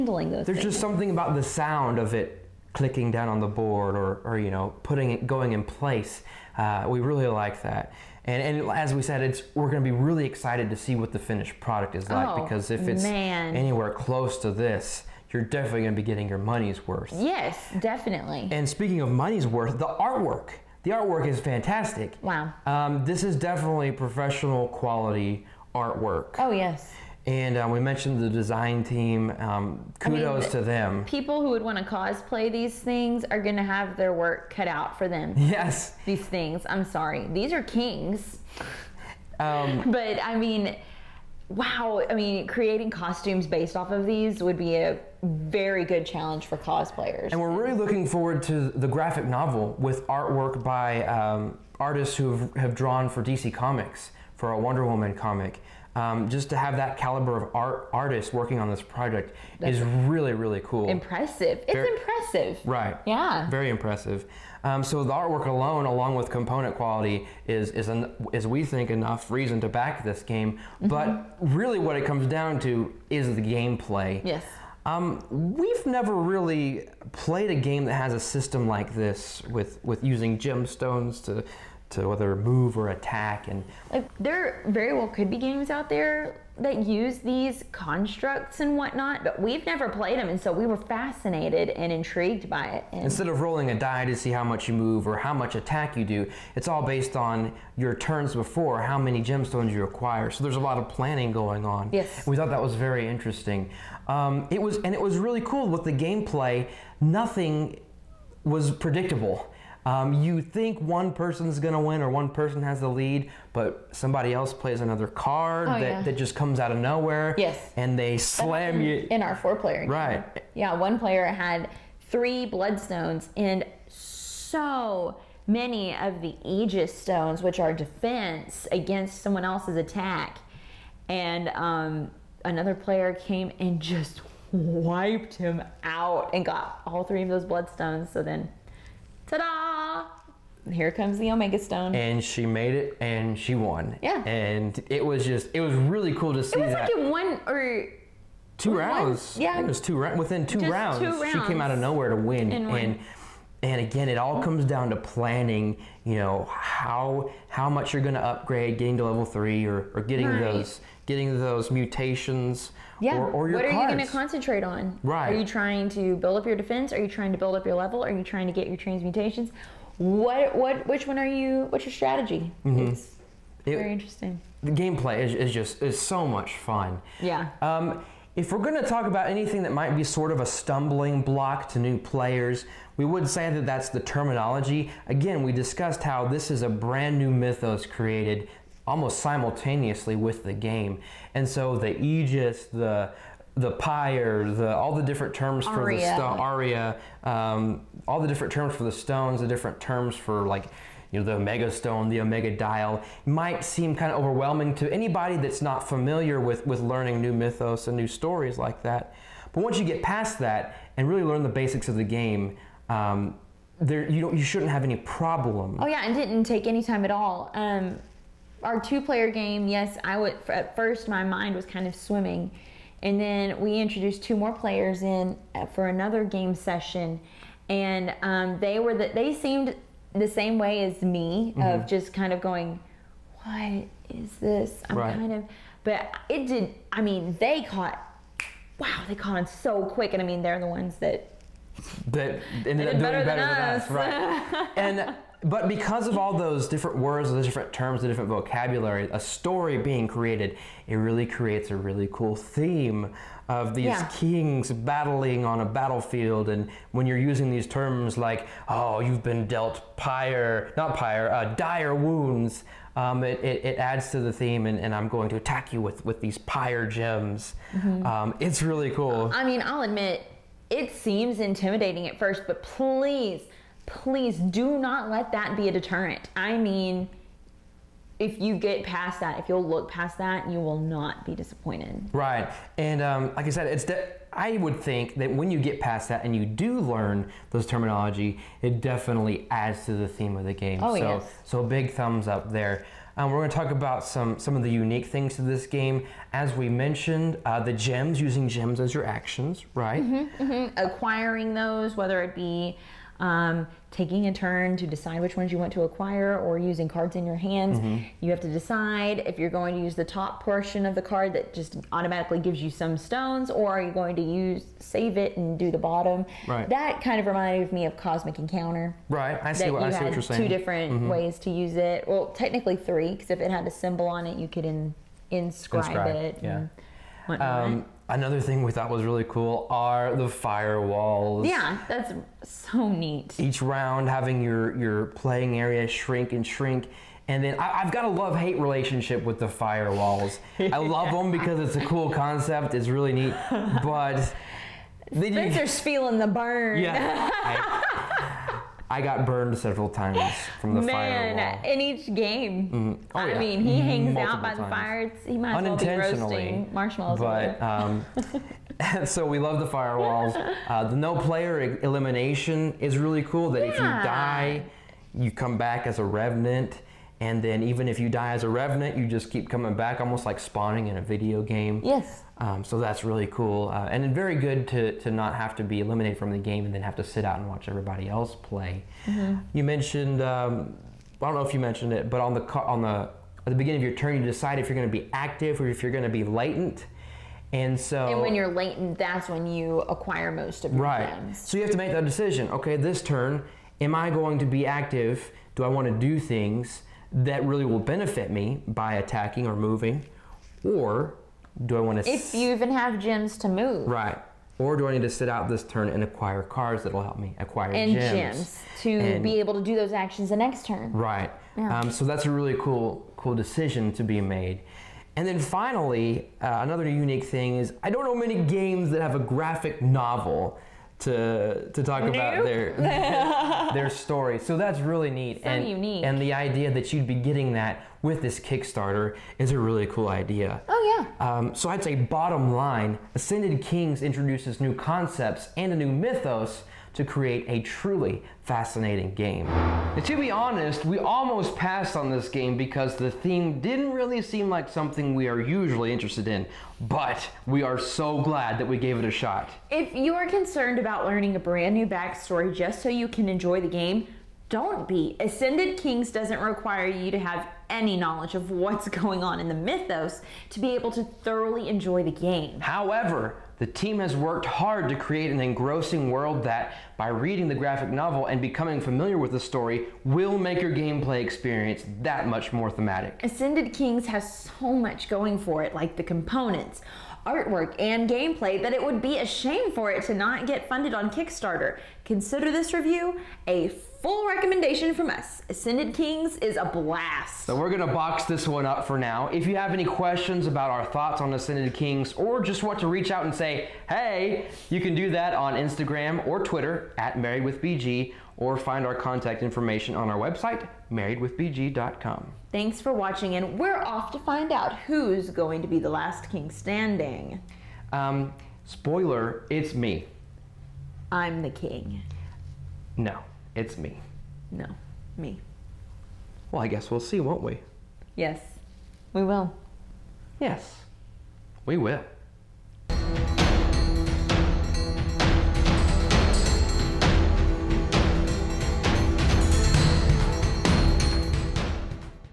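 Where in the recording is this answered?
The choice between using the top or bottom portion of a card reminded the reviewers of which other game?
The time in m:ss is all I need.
5:17.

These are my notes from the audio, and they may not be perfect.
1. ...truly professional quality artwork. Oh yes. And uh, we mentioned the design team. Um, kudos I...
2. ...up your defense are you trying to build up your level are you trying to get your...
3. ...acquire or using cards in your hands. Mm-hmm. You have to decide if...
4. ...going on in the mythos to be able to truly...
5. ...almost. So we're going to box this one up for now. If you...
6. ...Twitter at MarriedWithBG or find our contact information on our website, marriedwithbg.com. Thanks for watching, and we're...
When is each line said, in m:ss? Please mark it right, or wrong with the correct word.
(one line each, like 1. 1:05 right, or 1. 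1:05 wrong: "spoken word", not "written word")
1. 0:23 wrong: "definitely", not "truly"
2. 2:46 right
3. 5:05 right
4. 7:38 wrong: "thoroughly", not "truly"
5. 8:06 wrong: "blast", not "almost"
6. 8:16 right.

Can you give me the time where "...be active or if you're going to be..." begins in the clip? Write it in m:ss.
6:24.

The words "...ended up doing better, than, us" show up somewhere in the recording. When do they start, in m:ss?
4:02.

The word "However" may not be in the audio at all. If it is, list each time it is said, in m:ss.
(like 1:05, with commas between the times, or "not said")
7:42.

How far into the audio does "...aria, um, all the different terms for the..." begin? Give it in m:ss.
3:16.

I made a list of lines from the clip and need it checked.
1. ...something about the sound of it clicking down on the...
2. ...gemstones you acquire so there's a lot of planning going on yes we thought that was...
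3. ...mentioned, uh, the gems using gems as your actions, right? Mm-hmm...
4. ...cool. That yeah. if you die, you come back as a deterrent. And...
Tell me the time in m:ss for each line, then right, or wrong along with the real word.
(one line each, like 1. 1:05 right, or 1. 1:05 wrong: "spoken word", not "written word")
1. 0:00 right
2. 1:39 right
3. 4:56 right
4. 6:03 wrong: "revenant", not "deterrent".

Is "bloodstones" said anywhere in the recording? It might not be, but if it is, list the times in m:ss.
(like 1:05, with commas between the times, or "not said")
2:02, 2:17.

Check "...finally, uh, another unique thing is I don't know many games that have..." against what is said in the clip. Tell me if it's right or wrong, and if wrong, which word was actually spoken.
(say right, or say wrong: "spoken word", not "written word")
right.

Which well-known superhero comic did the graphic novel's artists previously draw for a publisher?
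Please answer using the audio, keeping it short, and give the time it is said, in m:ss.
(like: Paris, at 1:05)
Wonder Woman, at 0:54.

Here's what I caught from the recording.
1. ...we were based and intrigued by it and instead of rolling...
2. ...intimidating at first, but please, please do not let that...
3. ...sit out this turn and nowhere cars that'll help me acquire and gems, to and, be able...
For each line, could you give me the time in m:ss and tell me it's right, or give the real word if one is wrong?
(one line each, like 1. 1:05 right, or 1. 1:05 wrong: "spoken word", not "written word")
1. 1:30 wrong: "fascinated", not "based"
2. 4:31 right
3. 6:45 wrong: "acquire", not "nowhere".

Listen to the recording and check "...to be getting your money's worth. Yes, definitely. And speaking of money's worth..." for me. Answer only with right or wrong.
right.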